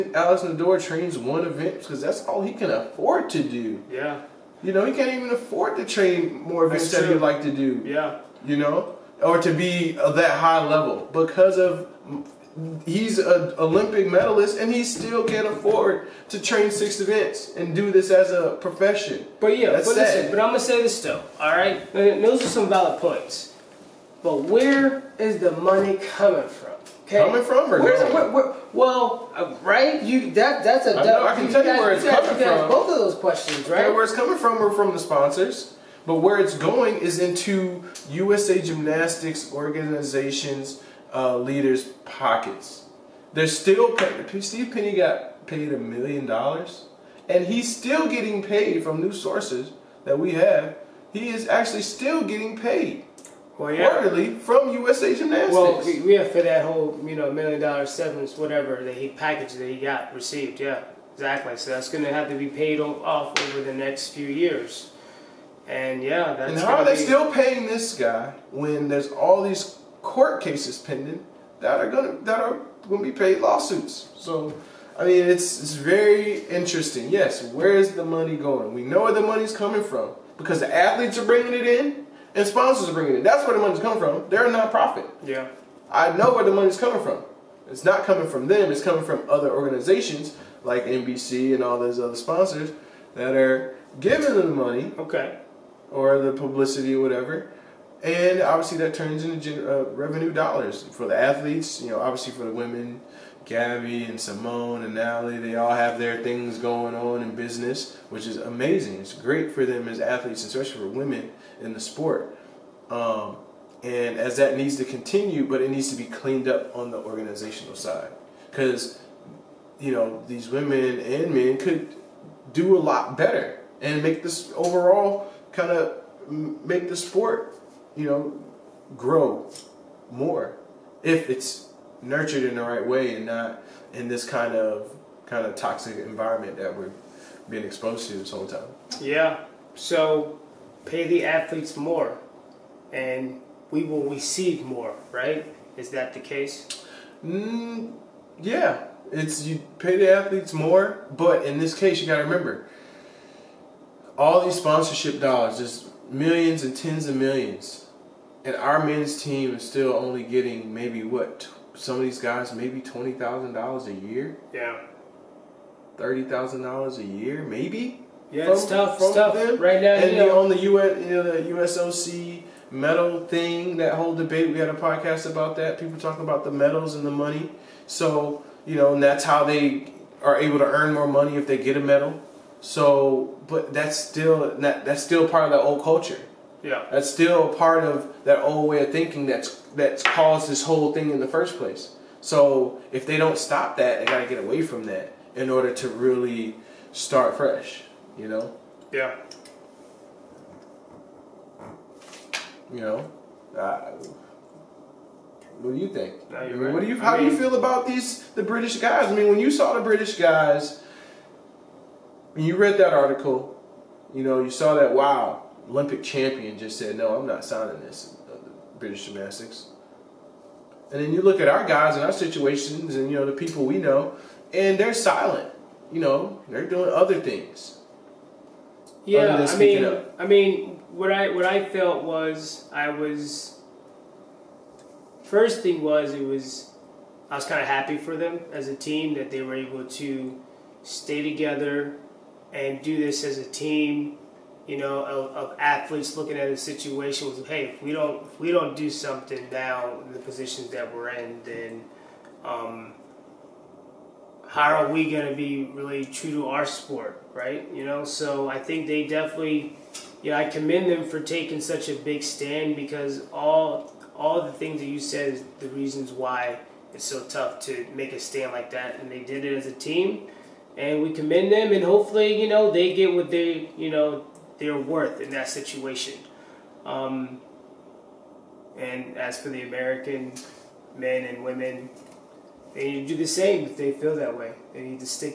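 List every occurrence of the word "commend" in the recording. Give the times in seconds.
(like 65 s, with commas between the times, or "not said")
260 s, 271 s.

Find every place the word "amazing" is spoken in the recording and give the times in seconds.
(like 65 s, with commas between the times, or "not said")
108 s.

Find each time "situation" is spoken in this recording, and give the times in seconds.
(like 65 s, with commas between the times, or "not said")
222 s, 246 s, 275 s.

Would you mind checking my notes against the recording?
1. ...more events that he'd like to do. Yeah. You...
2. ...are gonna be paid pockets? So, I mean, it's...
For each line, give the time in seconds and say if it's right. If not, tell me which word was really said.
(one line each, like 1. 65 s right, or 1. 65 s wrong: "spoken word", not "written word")
1. 6 s right
2. 72 s wrong: "lawsuits", not "pockets".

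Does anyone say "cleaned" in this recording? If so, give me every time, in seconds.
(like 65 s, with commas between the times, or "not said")
116 s.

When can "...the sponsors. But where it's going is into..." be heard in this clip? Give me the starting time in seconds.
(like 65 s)
34 s.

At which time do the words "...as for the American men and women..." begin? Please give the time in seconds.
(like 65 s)
279 s.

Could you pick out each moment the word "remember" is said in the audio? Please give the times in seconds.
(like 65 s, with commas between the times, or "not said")
152 s.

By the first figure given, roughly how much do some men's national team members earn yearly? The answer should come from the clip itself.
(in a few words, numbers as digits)
$20,000.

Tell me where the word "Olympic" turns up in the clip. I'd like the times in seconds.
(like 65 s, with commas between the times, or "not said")
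13 s, 215 s.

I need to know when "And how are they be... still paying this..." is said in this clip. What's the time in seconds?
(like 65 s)
66 s.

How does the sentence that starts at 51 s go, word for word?
He is actually still getting paid well, yeah.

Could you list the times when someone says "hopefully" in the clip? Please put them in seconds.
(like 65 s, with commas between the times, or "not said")
271 s.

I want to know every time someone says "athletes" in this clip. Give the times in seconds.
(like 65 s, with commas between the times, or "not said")
80 s, 101 s, 109 s, 141 s, 150 s, 245 s.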